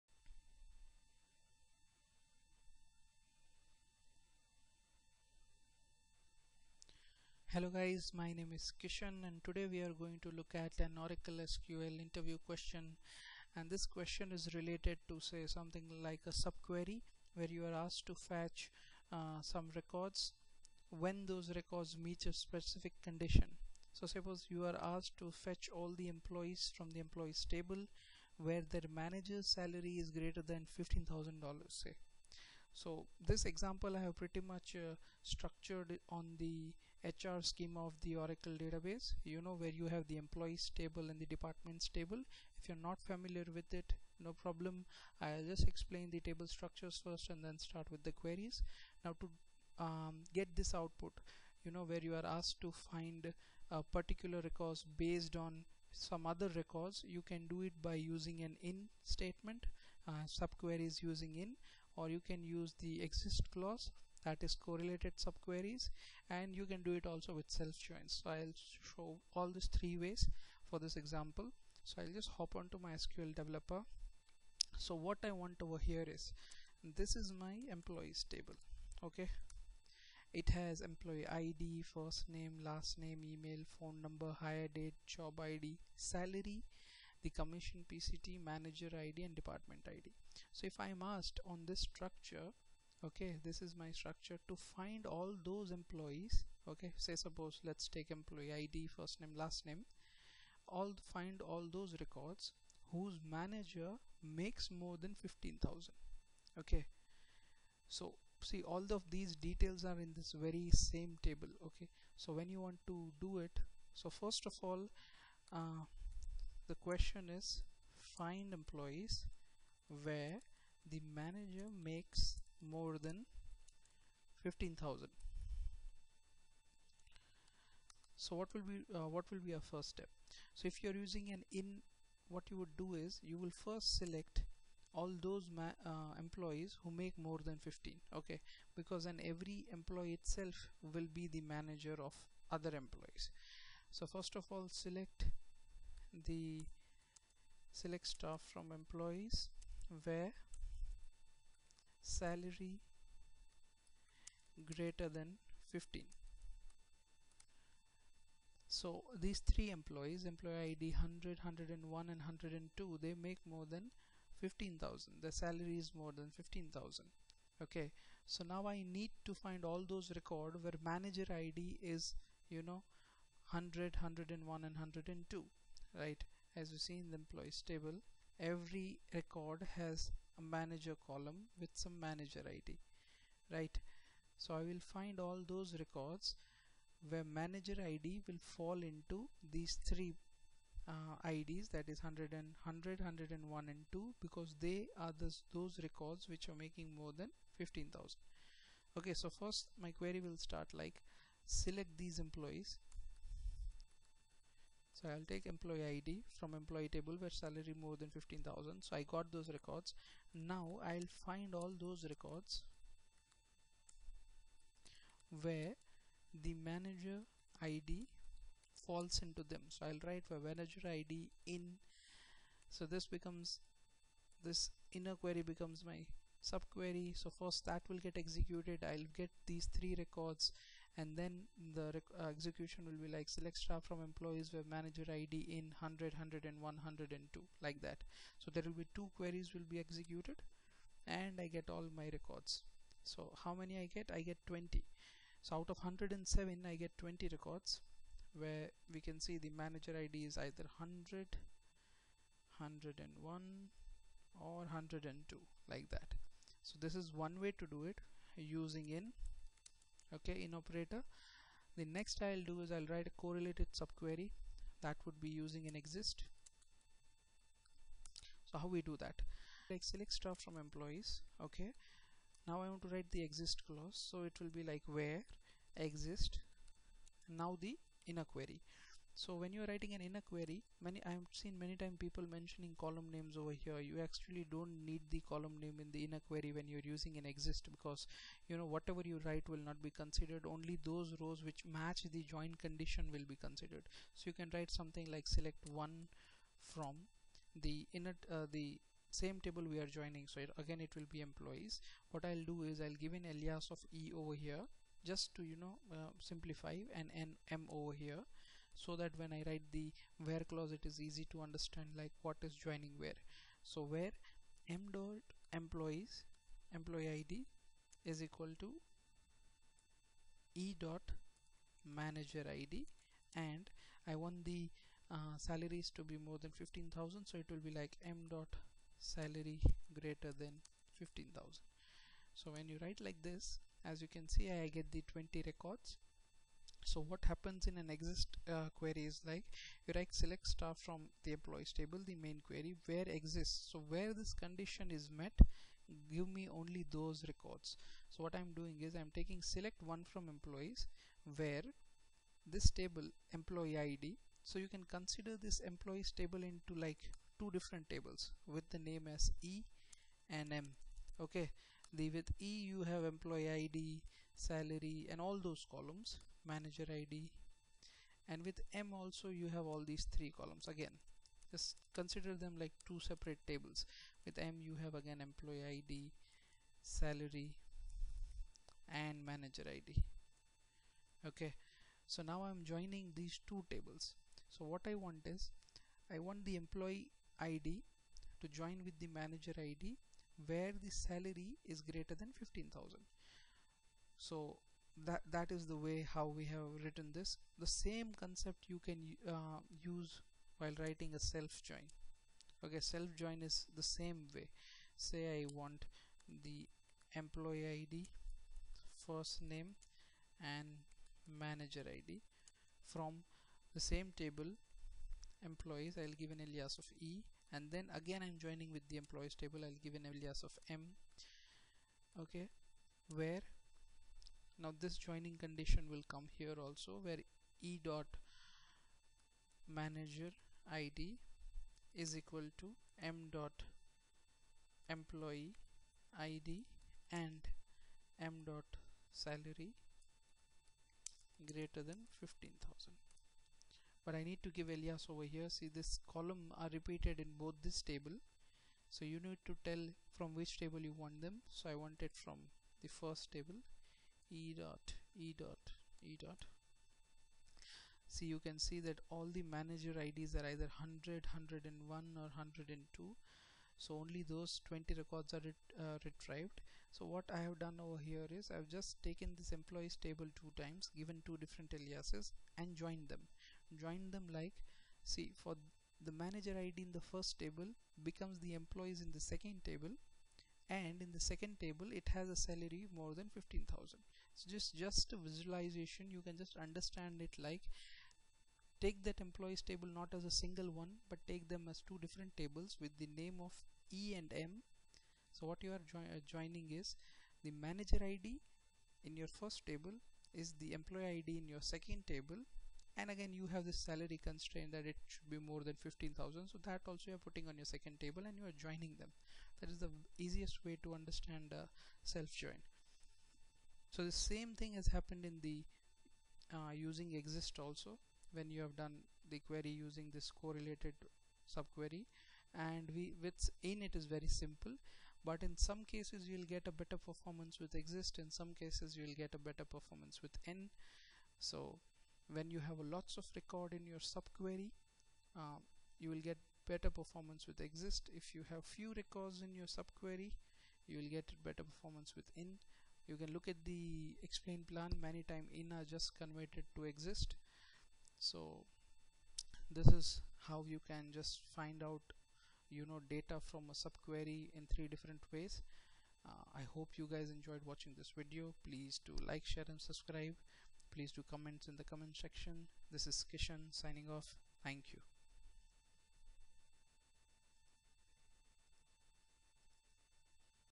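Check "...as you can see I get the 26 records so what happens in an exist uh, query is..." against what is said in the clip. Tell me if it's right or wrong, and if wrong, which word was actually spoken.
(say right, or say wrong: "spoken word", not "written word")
wrong: "20", not "26".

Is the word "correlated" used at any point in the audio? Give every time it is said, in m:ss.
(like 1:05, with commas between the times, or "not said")
1:04, 4:23, 8:40.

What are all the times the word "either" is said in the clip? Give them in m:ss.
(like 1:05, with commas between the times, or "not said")
4:10, 7:40.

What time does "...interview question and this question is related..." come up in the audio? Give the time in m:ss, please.
0:11.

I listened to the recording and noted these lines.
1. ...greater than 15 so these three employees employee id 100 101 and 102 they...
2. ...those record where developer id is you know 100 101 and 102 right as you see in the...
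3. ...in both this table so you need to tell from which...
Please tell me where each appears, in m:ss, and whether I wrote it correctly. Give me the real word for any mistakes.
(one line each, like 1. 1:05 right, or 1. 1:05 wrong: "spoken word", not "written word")
1. 2:34 right
2. 2:49 wrong: "manager", not "developer"
3. 7:27 right.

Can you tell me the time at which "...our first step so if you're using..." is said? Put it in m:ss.
2:09.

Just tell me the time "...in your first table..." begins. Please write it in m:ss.
8:19.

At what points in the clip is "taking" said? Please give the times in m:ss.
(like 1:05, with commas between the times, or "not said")
5:49.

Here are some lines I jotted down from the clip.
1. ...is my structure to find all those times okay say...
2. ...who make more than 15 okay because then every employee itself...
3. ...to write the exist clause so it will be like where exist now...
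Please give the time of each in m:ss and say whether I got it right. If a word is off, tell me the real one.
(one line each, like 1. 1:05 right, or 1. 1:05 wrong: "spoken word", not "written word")
1. 1:33 wrong: "employees", not "times"
2. 2:16 right
3. 4:32 right.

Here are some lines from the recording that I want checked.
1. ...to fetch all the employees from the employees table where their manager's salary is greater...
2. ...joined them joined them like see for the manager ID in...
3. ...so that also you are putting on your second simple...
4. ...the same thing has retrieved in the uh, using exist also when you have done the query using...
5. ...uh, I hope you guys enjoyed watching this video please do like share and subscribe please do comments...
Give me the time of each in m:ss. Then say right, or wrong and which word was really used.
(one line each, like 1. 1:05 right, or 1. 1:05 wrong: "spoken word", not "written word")
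1. 0:25 right
2. 7:52 right
3. 8:26 wrong: "table", not "simple"
4. 8:34 wrong: "happened", not "retrieved"
5. 9:16 right.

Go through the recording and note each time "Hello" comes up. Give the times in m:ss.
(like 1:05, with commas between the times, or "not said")
0:07.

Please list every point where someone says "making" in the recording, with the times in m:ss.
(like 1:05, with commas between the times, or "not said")
3:16.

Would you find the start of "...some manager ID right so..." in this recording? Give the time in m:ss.
3:01.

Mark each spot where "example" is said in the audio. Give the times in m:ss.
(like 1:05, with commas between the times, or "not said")
0:33, 1:10.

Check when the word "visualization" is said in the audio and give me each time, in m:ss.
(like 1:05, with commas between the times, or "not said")
8:05.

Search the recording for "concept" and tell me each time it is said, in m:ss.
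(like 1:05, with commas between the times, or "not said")
6:38.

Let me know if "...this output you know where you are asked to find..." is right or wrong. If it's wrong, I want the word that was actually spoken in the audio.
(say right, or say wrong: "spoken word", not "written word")
right.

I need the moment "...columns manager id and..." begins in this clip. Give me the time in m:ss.
6:05.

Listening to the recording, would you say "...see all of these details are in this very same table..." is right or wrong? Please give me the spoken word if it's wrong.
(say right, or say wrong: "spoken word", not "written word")
right.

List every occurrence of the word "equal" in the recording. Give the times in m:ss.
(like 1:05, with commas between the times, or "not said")
5:18, 7:12.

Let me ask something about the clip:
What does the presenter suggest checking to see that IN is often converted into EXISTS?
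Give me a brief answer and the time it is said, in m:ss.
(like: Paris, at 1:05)
Explain plan, at 9:04.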